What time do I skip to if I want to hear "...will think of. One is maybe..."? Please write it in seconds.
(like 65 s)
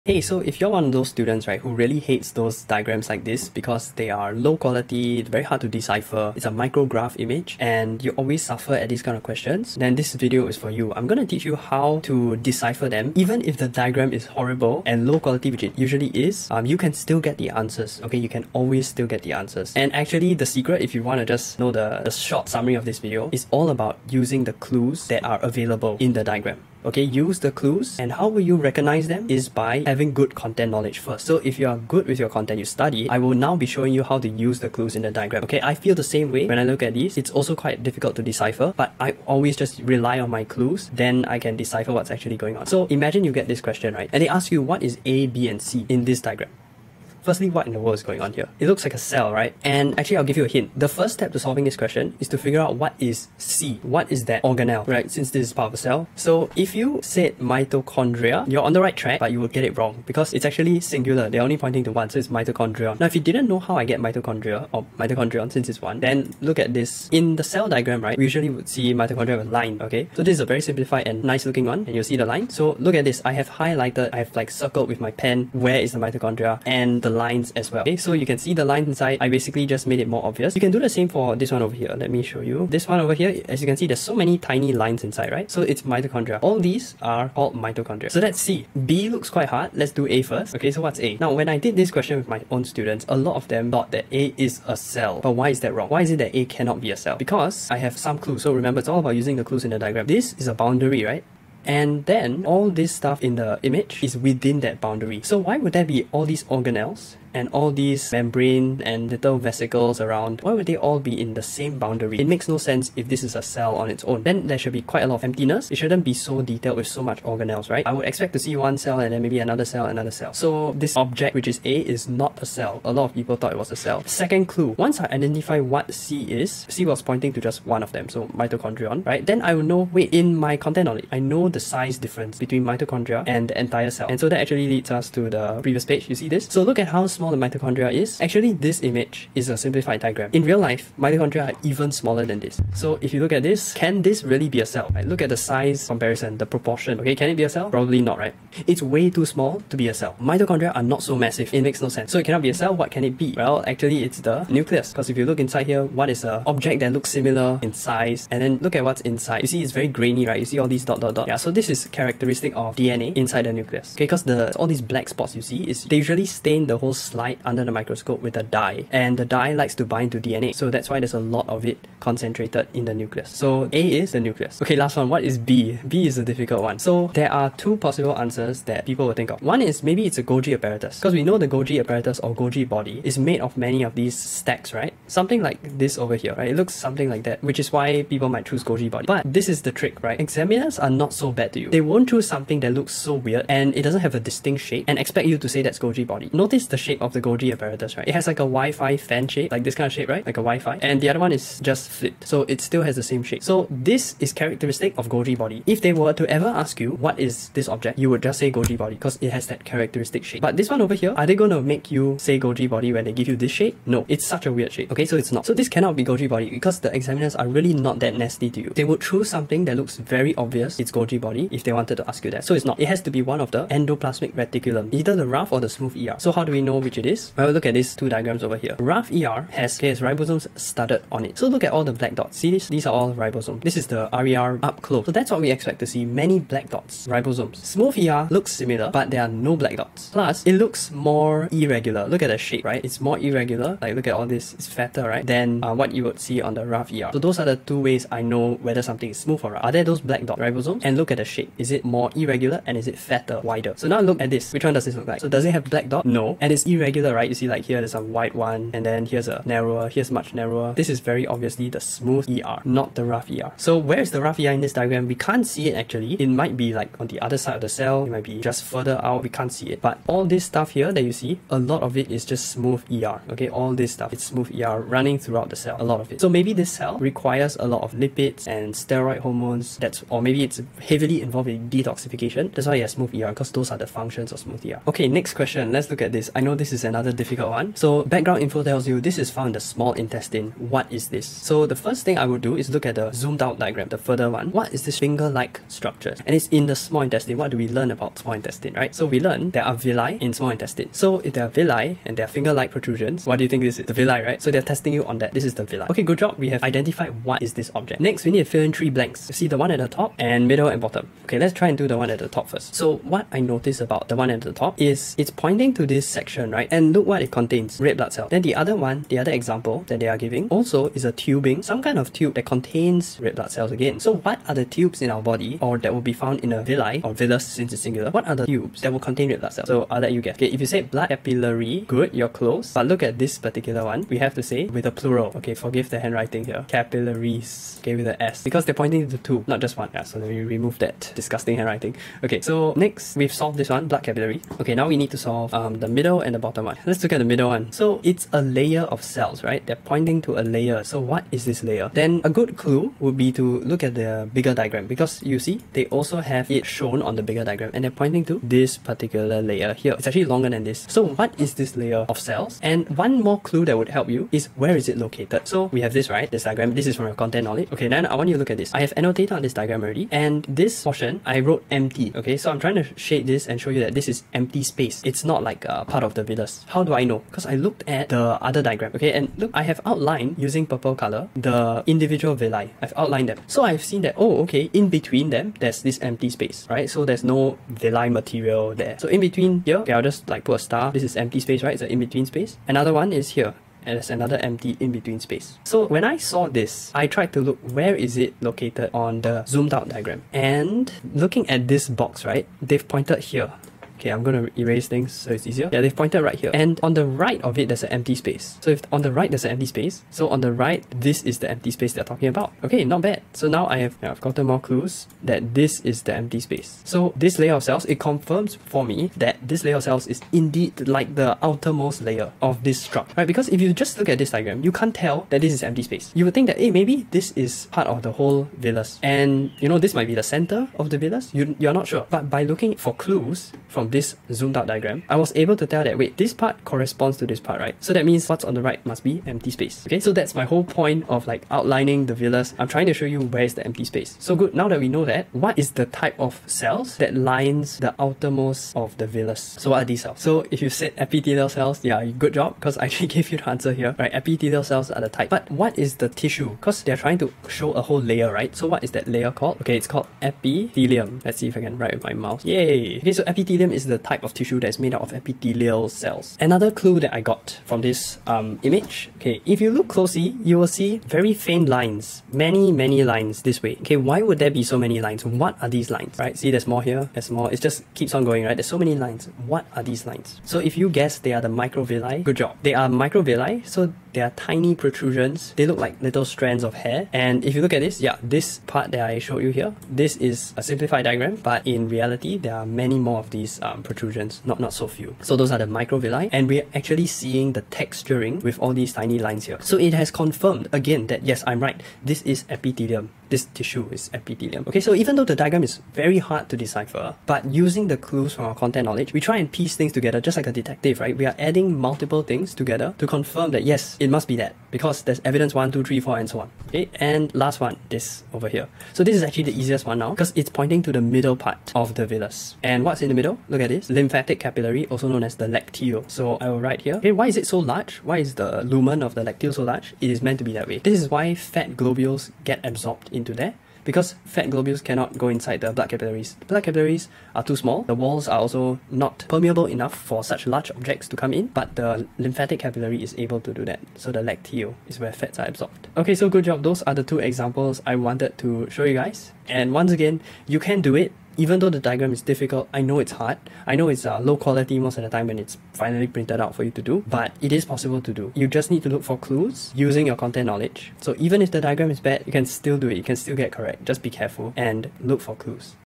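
179 s.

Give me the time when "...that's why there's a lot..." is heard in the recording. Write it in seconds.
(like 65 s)
170 s.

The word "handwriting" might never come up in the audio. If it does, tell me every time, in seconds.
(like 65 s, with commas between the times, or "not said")
335 s, 341 s.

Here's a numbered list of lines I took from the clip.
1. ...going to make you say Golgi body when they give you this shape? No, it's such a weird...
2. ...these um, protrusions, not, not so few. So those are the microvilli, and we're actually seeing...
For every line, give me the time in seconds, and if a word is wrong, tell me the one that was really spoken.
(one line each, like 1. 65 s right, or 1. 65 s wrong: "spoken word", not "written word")
1. 211 s right
2. 493 s right.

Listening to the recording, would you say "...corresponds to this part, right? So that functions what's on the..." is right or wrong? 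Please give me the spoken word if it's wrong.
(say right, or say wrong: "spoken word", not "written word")
wrong: "means", not "functions".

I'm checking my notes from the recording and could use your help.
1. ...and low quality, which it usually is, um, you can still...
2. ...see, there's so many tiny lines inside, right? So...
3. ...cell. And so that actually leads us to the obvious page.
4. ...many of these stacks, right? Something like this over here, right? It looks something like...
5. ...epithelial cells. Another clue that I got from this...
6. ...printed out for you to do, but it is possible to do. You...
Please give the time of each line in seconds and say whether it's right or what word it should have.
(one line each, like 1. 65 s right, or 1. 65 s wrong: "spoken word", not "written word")
1. 14 s right
2. 83 s right
3. 133 s wrong: "previous", not "obvious"
4. 183 s right
5. 465 s right
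6. 556 s right.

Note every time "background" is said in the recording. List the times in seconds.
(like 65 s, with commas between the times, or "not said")
288 s.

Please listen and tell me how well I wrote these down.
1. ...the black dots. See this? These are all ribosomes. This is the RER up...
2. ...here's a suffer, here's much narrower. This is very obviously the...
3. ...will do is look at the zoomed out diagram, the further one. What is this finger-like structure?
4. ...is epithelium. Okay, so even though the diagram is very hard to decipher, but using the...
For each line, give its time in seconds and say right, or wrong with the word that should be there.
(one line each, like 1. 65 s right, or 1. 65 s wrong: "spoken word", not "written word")
1. 231 s right
2. 259 s wrong: "narrower", not "suffer"
3. 292 s right
4. 503 s right.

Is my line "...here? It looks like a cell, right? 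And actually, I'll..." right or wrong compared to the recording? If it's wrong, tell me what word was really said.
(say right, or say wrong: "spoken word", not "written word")
right.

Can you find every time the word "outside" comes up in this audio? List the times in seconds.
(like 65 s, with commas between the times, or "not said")
not said.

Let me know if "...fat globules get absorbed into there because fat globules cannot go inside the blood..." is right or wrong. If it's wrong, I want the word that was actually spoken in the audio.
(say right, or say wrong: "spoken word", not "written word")
right.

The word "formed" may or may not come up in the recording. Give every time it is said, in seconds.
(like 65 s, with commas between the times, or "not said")
not said.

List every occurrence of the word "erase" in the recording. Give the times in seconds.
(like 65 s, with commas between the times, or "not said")
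404 s.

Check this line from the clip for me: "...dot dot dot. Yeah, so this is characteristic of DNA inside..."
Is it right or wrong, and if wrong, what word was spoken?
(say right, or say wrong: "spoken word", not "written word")
right.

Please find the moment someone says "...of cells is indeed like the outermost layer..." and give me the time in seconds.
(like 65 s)
419 s.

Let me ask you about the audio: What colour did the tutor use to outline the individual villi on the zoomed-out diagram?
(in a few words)
purple.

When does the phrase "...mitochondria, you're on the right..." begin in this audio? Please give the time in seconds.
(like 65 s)
57 s.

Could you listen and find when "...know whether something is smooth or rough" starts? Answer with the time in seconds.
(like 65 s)
248 s.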